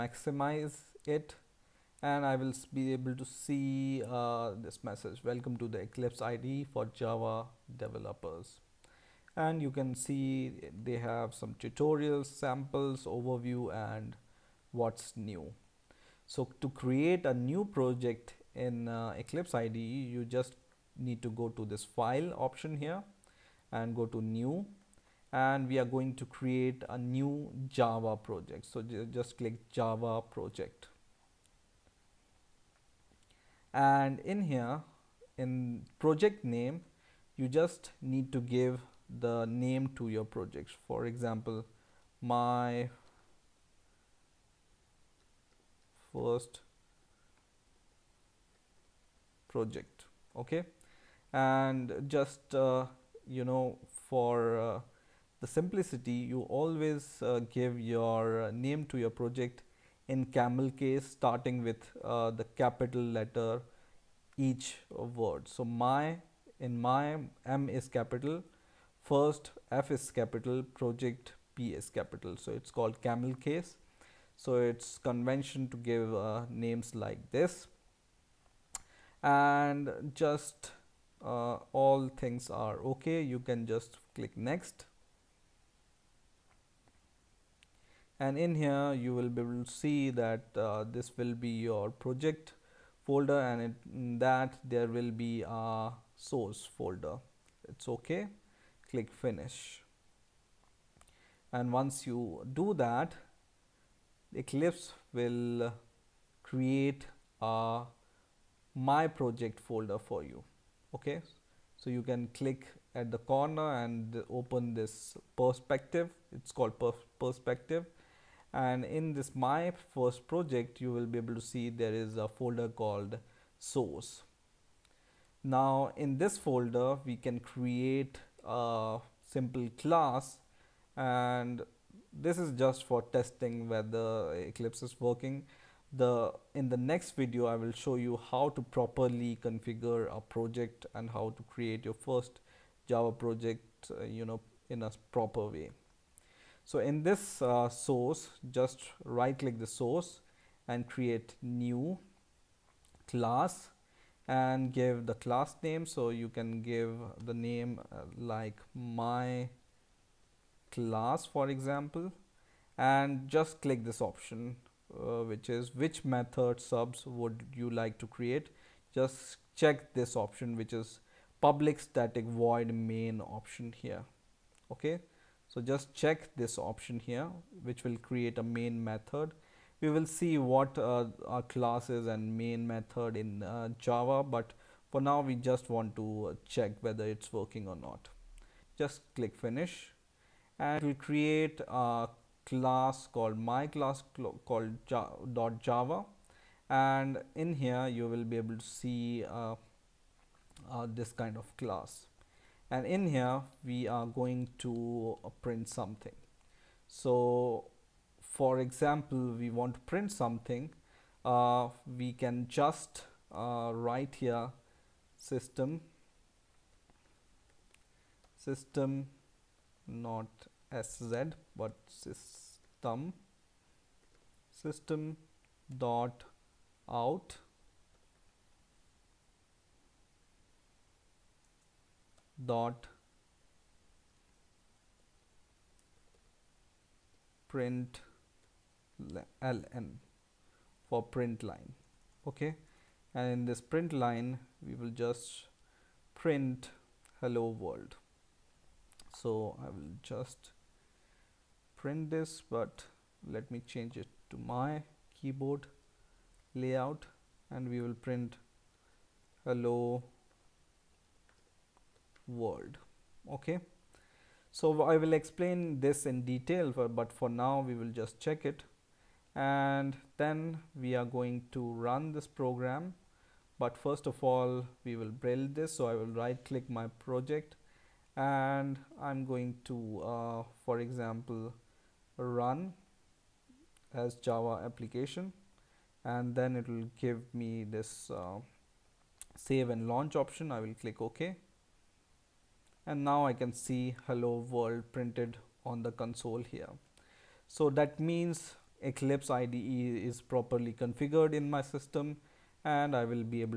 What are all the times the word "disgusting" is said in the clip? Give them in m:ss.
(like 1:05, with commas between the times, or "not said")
not said.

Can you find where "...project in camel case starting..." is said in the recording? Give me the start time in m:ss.
0:59.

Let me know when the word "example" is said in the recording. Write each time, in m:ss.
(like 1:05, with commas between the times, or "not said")
0:41, 2:41, 3:28, 4:40.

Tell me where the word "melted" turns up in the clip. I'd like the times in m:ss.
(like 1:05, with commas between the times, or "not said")
not said.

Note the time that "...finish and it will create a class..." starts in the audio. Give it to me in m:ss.
3:09.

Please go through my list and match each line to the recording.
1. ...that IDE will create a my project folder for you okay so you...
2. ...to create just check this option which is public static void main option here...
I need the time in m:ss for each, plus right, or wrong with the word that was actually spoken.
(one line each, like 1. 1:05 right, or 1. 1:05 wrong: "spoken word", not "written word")
1. 1:42 wrong: "Eclipse", not "IDE"
2. 2:47 right.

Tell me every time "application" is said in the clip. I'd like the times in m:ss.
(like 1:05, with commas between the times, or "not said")
4:44.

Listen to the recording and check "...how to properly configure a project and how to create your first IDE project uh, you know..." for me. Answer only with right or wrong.
wrong.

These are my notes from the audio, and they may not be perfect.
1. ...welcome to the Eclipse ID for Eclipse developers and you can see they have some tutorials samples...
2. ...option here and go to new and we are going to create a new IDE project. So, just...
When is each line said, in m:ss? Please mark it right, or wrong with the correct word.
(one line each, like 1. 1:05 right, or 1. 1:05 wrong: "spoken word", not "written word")
1. 0:05 wrong: "Java", not "Eclipse"
2. 0:22 wrong: "Java", not "IDE".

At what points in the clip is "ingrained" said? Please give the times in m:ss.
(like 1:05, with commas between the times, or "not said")
not said.